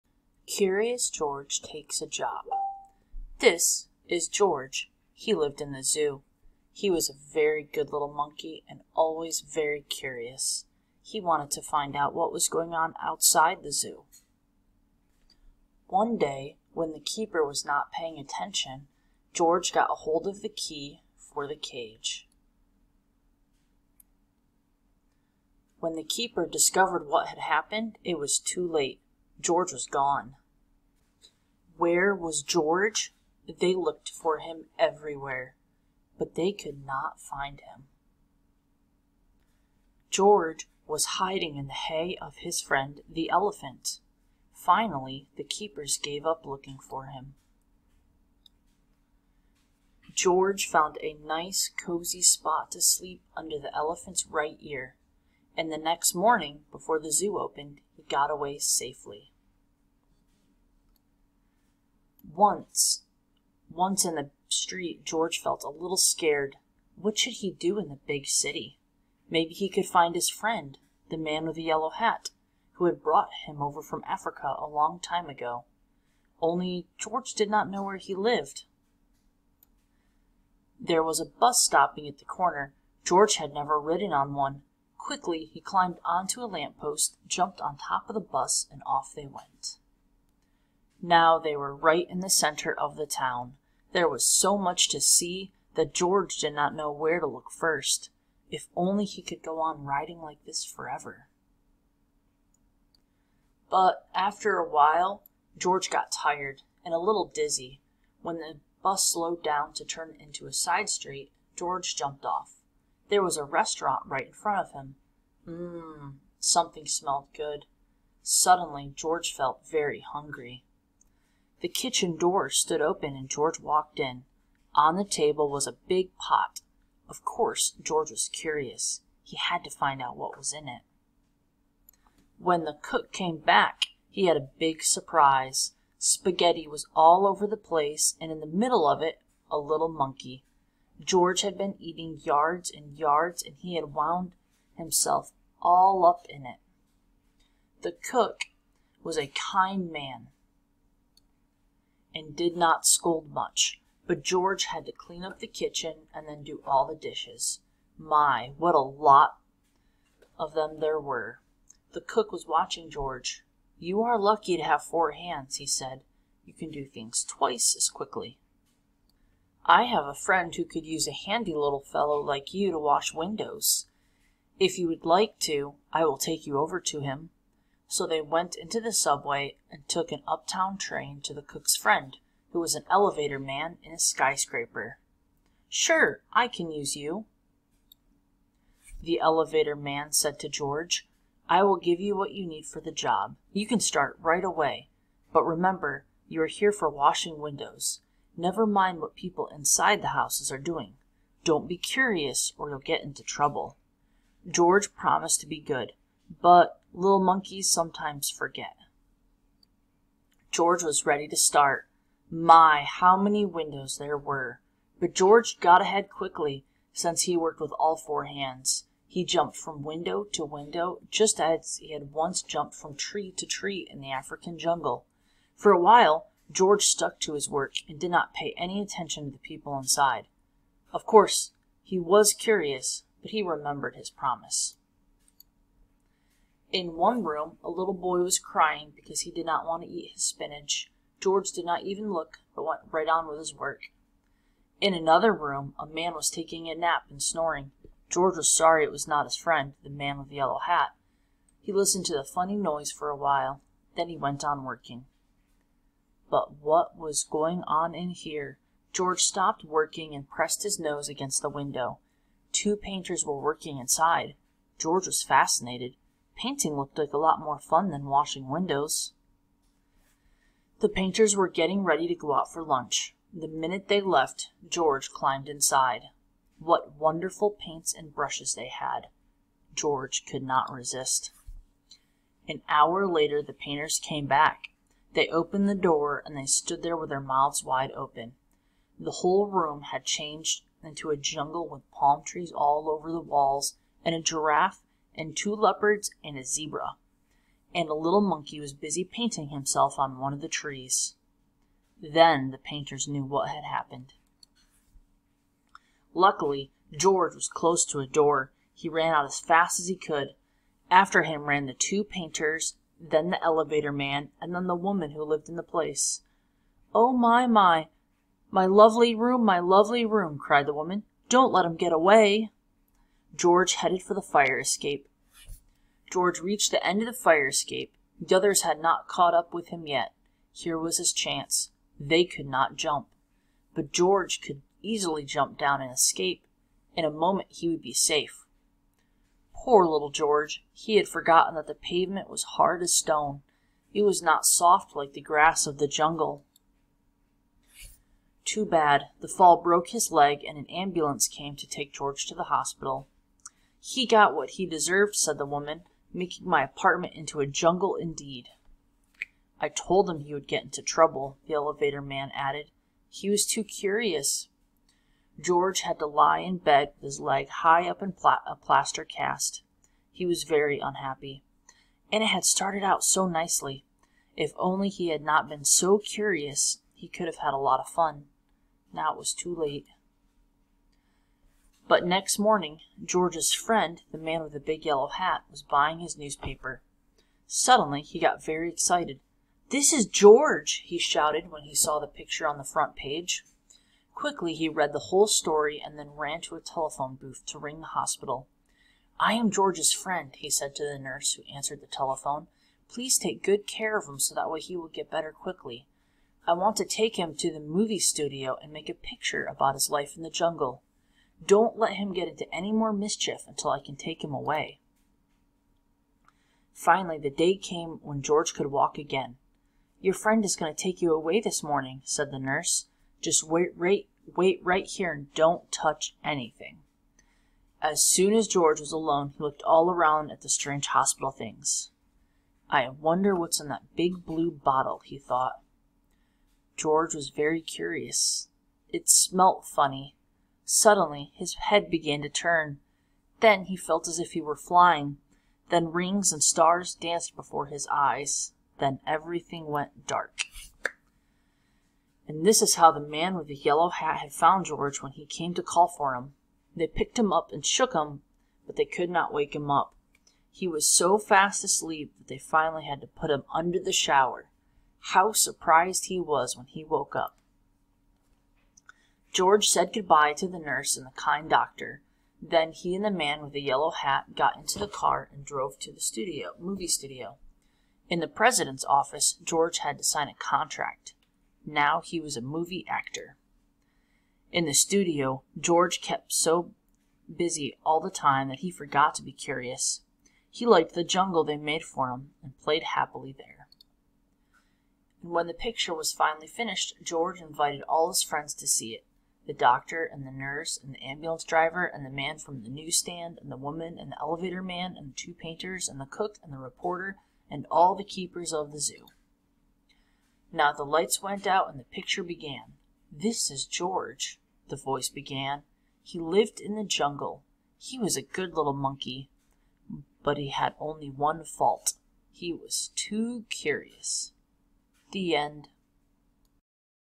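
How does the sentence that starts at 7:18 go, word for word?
It smelt funny, Suddenly his head began to turn.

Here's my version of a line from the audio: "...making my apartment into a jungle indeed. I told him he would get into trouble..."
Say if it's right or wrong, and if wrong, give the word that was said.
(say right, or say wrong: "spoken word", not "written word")
right.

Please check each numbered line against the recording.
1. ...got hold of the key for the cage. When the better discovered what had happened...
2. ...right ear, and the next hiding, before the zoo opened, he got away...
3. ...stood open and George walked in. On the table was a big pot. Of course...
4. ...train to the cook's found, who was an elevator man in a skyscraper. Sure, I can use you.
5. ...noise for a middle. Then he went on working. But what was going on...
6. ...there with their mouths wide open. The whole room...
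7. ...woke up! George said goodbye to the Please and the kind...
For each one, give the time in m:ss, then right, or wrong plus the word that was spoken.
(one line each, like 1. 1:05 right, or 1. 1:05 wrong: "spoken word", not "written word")
1. 0:19 wrong: "keeper", not "better"
2. 0:54 wrong: "morning", not "hiding"
3. 2:02 right
4. 3:00 wrong: "friend", not "found"
5. 4:12 wrong: "while", not "middle"
6. 4:46 right
7. 7:46 wrong: "nurse", not "Please".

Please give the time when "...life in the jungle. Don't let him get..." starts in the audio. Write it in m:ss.
6:49.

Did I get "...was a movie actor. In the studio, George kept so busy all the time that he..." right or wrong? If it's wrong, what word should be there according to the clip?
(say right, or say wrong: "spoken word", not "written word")
right.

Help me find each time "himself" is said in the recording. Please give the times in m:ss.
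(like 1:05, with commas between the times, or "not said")
2:24, 4:59.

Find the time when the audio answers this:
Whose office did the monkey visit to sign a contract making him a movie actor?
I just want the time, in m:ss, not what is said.
7:58.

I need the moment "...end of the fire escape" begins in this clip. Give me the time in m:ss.
5:26.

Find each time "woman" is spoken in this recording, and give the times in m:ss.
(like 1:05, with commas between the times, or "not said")
5:14, 5:20, 5:55, 8:23.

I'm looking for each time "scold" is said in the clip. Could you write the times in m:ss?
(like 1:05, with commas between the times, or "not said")
2:32.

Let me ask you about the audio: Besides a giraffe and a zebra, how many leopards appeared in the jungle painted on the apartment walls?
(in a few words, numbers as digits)
2.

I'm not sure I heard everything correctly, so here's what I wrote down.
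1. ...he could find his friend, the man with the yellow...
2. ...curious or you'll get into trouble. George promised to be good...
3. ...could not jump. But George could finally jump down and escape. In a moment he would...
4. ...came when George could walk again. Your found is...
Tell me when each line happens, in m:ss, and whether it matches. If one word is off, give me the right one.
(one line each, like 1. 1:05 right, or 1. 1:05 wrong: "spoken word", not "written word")
1. 1:09 right
2. 3:21 right
3. 5:32 wrong: "easily", not "finally"
4. 6:57 wrong: "friend", not "found".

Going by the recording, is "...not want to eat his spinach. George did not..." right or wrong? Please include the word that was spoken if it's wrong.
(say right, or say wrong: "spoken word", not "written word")
right.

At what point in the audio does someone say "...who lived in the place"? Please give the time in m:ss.
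5:15.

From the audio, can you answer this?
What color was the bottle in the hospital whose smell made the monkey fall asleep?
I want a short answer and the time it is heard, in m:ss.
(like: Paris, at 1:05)
Blue, at 7:13.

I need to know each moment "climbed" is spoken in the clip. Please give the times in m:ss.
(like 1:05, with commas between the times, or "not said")
1:25, 4:35.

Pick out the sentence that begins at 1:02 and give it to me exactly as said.
Once, once in the street, George felt a little scared.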